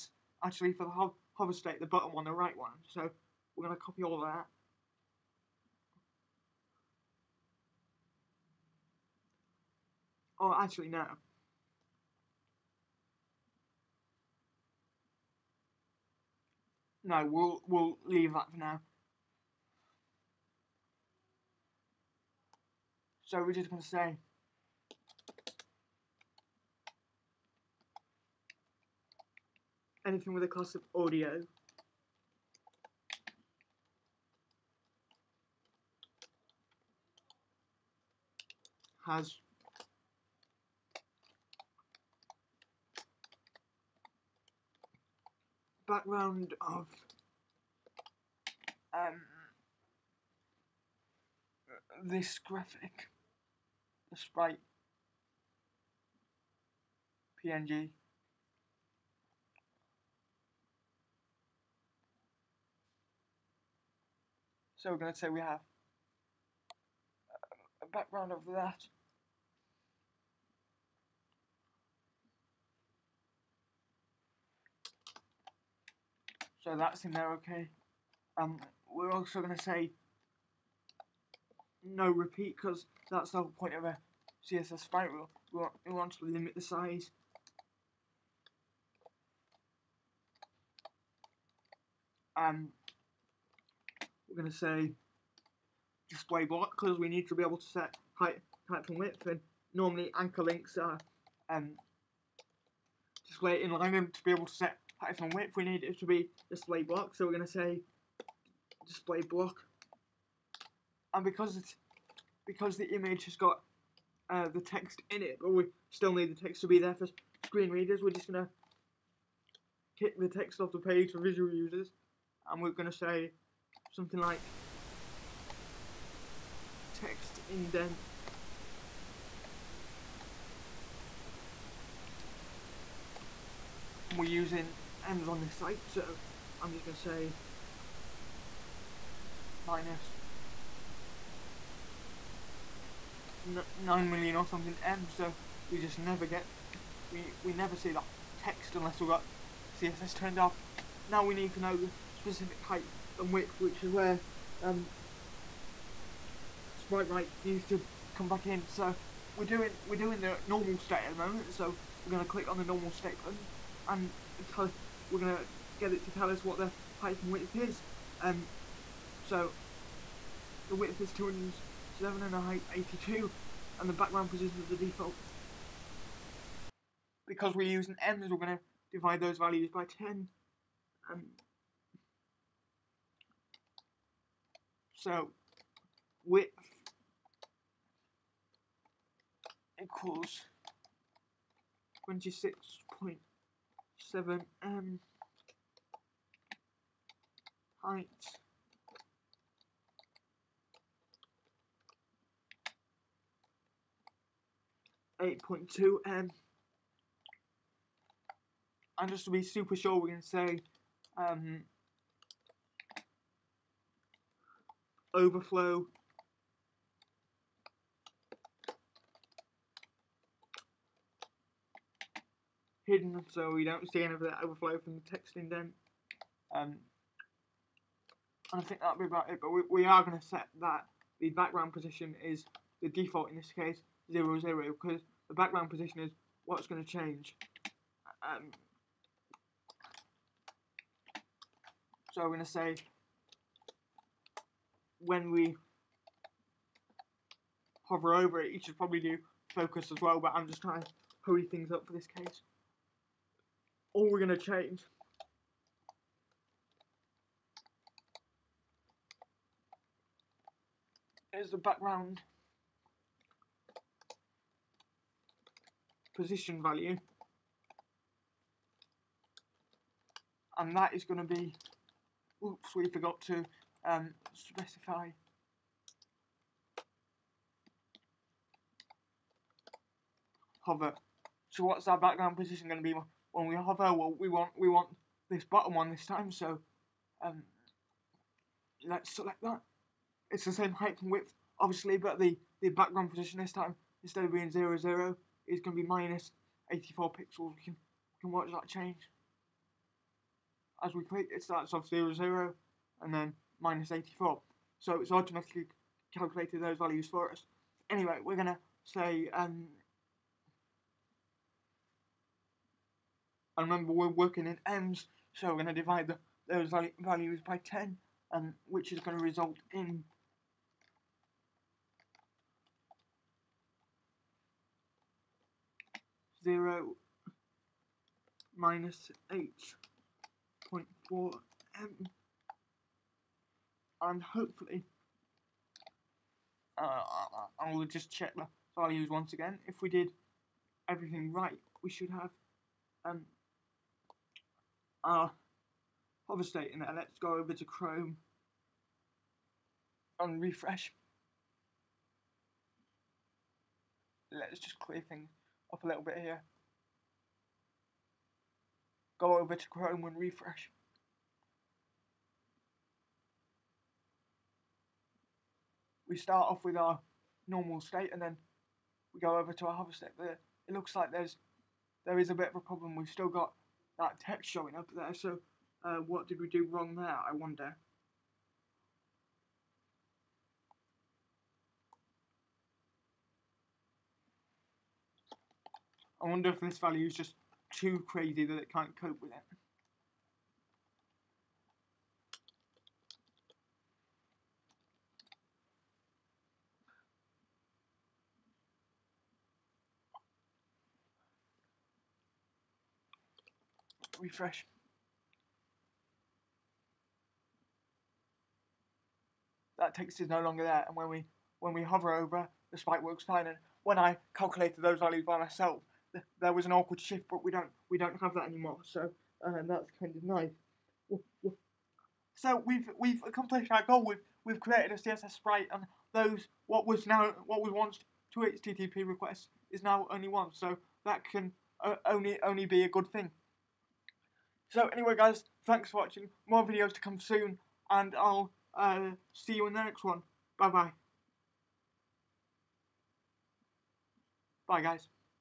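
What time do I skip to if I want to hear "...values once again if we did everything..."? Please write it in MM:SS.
05:38.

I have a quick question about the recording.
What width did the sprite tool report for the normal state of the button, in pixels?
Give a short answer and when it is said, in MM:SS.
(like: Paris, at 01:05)
207, at 02:51.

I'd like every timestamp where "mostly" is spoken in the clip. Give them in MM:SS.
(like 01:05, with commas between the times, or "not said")
not said.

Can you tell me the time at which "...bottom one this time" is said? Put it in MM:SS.
04:45.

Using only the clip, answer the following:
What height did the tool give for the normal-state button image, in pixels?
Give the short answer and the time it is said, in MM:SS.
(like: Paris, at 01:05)
82, at 02:52.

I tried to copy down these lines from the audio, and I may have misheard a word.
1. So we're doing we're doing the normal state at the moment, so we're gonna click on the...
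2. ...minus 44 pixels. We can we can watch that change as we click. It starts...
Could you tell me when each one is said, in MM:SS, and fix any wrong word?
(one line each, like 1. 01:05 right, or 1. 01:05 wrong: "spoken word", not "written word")
1. 02:38 right
2. 04:55 wrong: "84", not "44".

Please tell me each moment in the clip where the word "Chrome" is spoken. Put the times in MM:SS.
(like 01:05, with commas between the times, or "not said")
05:47, 05:59.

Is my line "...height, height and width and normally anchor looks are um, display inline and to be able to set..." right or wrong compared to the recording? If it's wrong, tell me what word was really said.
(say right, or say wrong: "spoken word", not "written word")
wrong: "links", not "looks".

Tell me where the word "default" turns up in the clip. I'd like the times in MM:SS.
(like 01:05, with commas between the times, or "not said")
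02:54, 03:52.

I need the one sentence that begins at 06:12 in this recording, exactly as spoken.
We've still got that text showing up there.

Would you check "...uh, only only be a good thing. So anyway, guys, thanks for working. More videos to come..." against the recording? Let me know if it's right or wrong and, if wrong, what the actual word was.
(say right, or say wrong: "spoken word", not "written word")
wrong: "watching", not "working".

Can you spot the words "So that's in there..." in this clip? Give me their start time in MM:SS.
01:16.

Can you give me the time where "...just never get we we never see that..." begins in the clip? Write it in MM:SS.
02:25.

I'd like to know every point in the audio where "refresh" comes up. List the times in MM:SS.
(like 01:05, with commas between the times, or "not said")
05:50, 06:00, 06:44.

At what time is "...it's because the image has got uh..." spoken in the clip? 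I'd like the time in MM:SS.
01:51.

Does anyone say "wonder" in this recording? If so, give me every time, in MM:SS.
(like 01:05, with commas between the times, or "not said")
06:17, 06:26.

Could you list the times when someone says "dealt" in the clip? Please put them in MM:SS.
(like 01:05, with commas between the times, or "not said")
not said.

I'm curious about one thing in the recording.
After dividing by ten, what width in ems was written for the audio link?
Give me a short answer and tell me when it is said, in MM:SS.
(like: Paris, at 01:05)
26.7 em, at 03:12.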